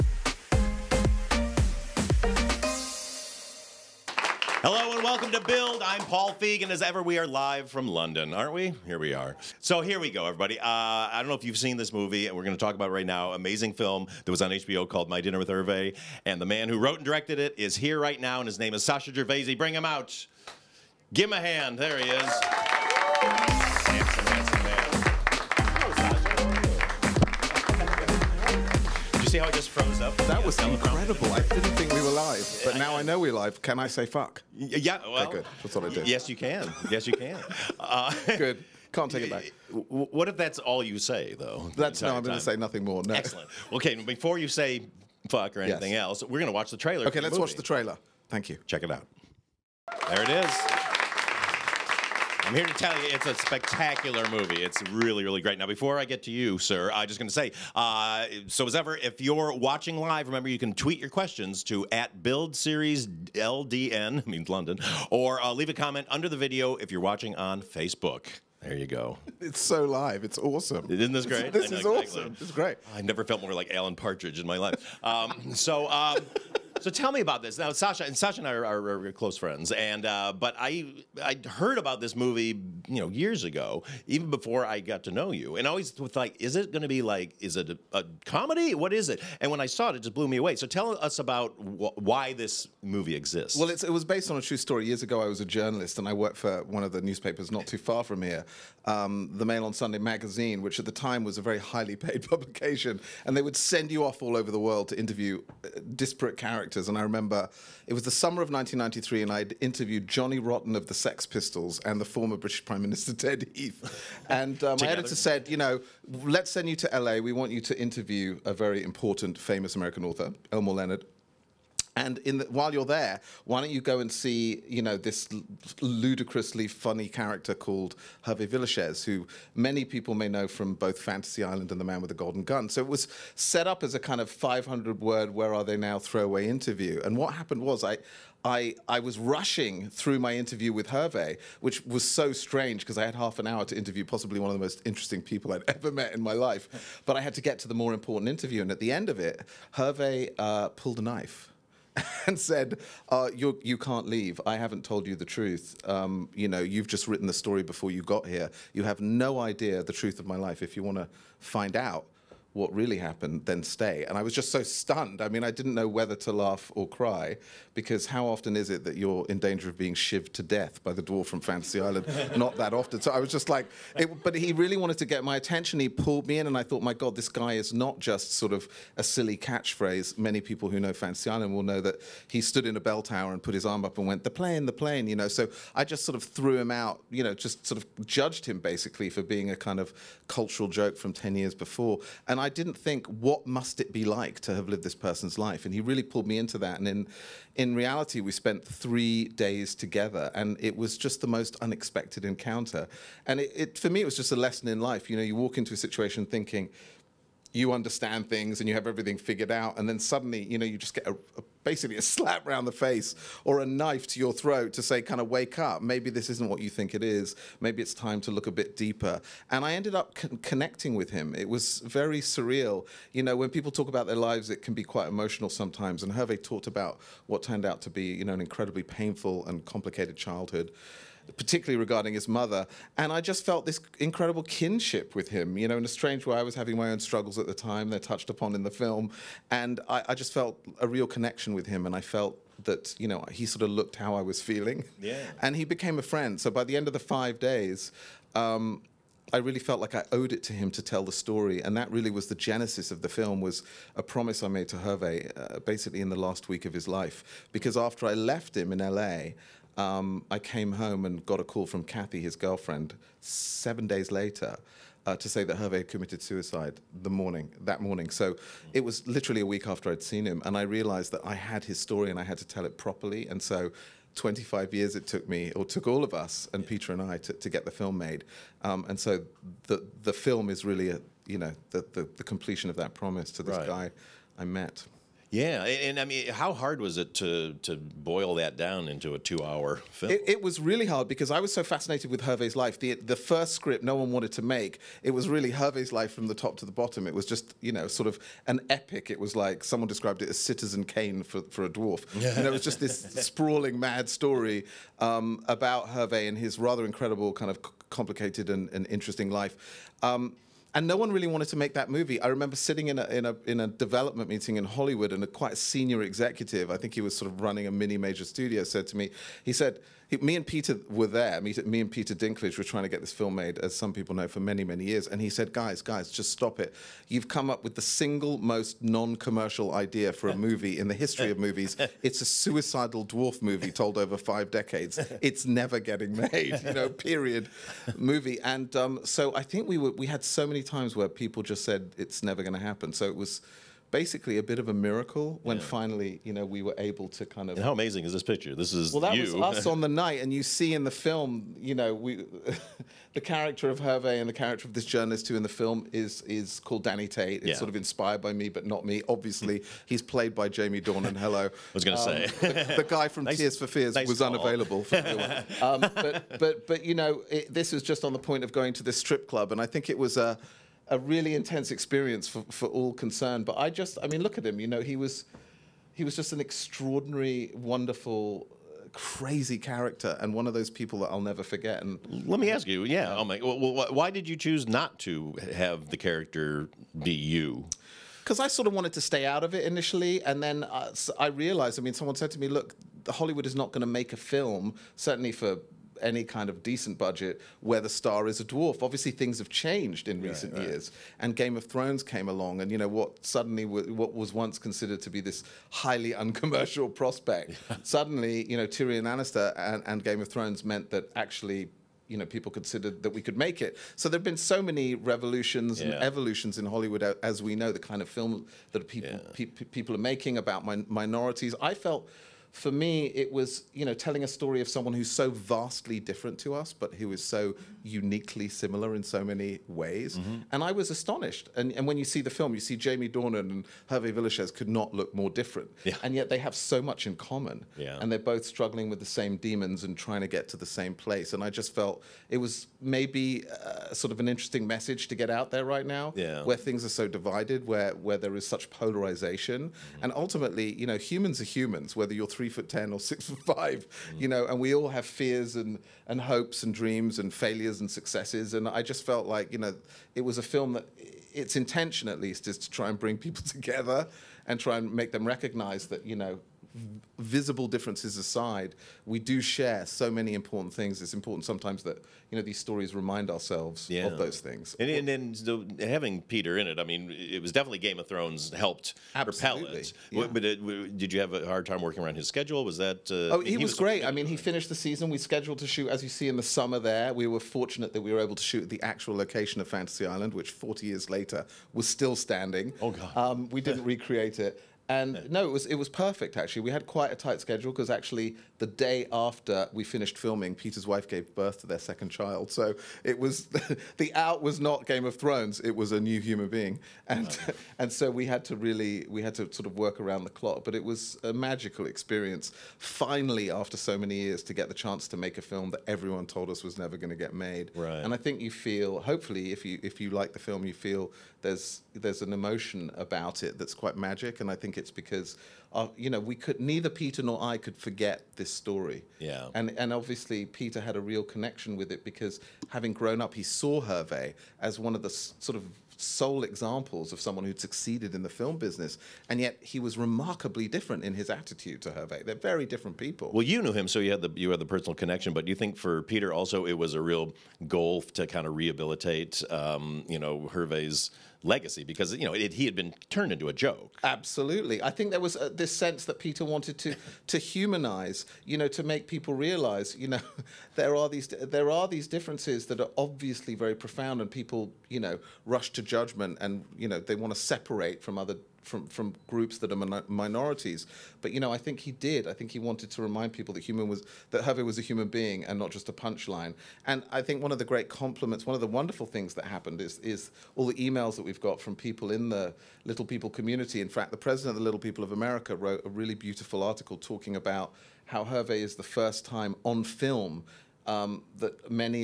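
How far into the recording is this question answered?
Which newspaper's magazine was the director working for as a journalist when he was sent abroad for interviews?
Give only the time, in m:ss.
1:39.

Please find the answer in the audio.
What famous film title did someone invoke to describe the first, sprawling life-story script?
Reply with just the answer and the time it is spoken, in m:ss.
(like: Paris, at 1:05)
Citizen Kane, at 5:00.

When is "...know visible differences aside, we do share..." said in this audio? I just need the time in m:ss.
7:46.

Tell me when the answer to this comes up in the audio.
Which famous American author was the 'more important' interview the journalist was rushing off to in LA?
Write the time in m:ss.
2:00.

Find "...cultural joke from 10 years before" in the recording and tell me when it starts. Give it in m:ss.
3:10.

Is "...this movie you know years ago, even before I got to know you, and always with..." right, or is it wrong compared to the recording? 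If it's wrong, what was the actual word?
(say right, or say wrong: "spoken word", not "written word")
right.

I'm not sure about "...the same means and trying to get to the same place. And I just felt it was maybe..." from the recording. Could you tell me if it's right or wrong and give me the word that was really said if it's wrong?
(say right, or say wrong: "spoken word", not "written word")
wrong: "demons", not "means".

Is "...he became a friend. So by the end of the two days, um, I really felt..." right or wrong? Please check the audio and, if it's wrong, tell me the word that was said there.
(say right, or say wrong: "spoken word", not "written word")
wrong: "five", not "two".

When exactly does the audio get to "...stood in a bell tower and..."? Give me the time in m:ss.
3:02.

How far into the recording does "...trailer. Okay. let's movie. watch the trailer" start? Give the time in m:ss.
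0:46.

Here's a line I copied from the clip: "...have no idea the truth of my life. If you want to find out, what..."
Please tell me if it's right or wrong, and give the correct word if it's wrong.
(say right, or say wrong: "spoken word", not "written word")
right.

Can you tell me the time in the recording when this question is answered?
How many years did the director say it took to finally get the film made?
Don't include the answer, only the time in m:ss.
4:34.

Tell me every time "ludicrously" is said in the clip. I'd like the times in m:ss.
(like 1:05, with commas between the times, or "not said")
2:05.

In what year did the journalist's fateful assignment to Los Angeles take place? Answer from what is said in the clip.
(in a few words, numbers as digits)
1993.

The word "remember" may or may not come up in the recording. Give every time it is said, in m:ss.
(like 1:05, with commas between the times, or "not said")
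1:00, 1:47, 5:12.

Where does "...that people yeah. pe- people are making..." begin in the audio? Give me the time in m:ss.
6:58.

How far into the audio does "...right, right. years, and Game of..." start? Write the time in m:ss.
6:40.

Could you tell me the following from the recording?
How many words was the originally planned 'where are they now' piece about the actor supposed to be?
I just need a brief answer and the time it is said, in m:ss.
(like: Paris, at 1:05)
500, at 2:14.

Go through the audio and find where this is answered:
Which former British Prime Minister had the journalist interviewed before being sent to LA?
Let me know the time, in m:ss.
1:53.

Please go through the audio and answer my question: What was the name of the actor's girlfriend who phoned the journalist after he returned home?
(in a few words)
Kathy.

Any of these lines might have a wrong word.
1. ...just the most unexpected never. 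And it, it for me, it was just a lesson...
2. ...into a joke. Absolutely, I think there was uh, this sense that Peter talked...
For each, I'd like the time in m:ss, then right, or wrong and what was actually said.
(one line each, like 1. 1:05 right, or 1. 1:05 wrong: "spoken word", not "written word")
1. 3:20 wrong: "encounter", not "never"
2. 9:13 wrong: "wanted", not "talked".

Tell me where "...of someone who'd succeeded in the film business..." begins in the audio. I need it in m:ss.
8:57.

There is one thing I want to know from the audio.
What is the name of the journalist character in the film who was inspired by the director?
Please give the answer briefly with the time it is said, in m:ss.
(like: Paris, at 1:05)
Danny Tate, at 5:56.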